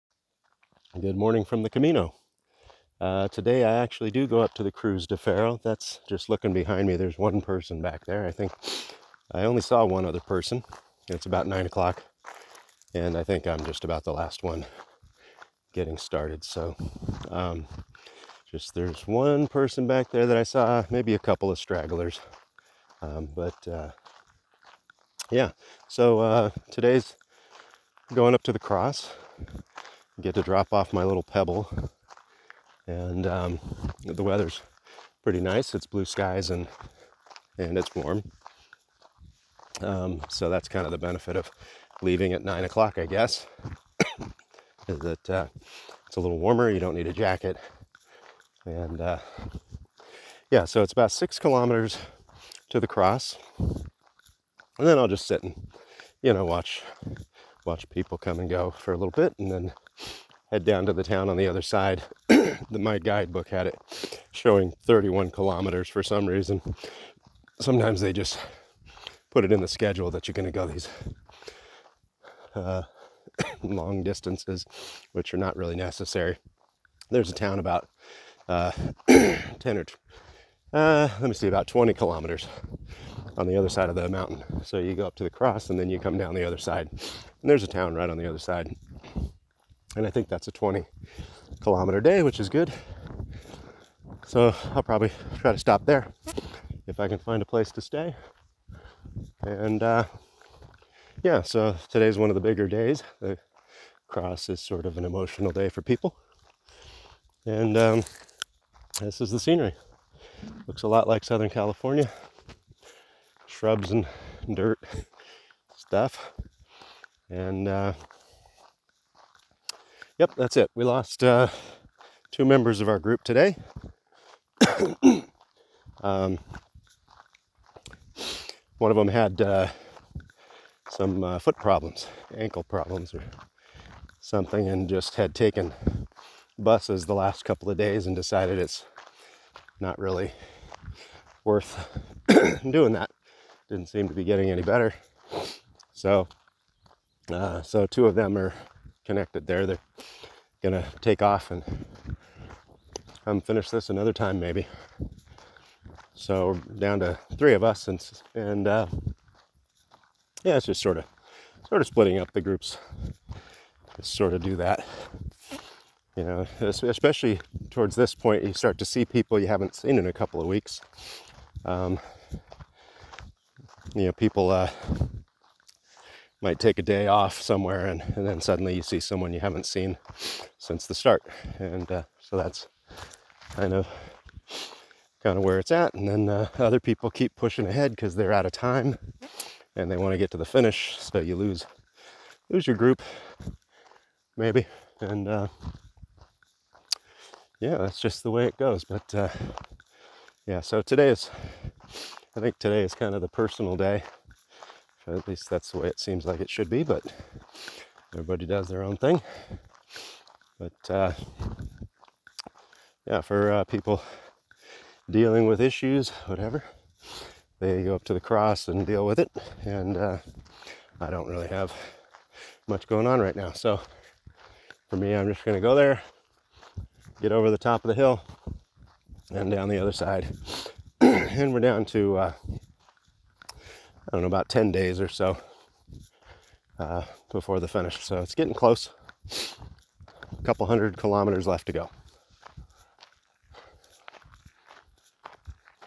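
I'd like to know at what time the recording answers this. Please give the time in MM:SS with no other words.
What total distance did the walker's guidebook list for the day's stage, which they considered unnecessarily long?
01:04.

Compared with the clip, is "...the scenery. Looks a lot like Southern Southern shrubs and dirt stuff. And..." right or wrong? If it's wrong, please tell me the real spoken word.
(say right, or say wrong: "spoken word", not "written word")
wrong: "California", not "Southern".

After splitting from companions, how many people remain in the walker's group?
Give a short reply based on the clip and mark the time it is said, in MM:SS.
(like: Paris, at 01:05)
3, at 02:37.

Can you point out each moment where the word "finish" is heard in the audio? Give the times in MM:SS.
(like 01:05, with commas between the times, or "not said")
02:33, 03:10, 03:57.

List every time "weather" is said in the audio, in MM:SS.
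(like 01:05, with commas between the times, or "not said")
00:34.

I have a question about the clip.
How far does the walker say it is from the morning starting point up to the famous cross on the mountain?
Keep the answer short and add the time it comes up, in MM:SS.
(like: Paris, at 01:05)
6 kilometers, at 00:51.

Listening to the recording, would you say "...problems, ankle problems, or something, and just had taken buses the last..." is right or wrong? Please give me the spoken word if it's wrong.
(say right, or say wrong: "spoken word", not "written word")
right.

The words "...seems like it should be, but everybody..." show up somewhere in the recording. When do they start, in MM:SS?
03:25.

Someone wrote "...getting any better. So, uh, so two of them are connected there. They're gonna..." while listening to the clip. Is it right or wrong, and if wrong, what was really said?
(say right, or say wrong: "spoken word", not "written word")
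right.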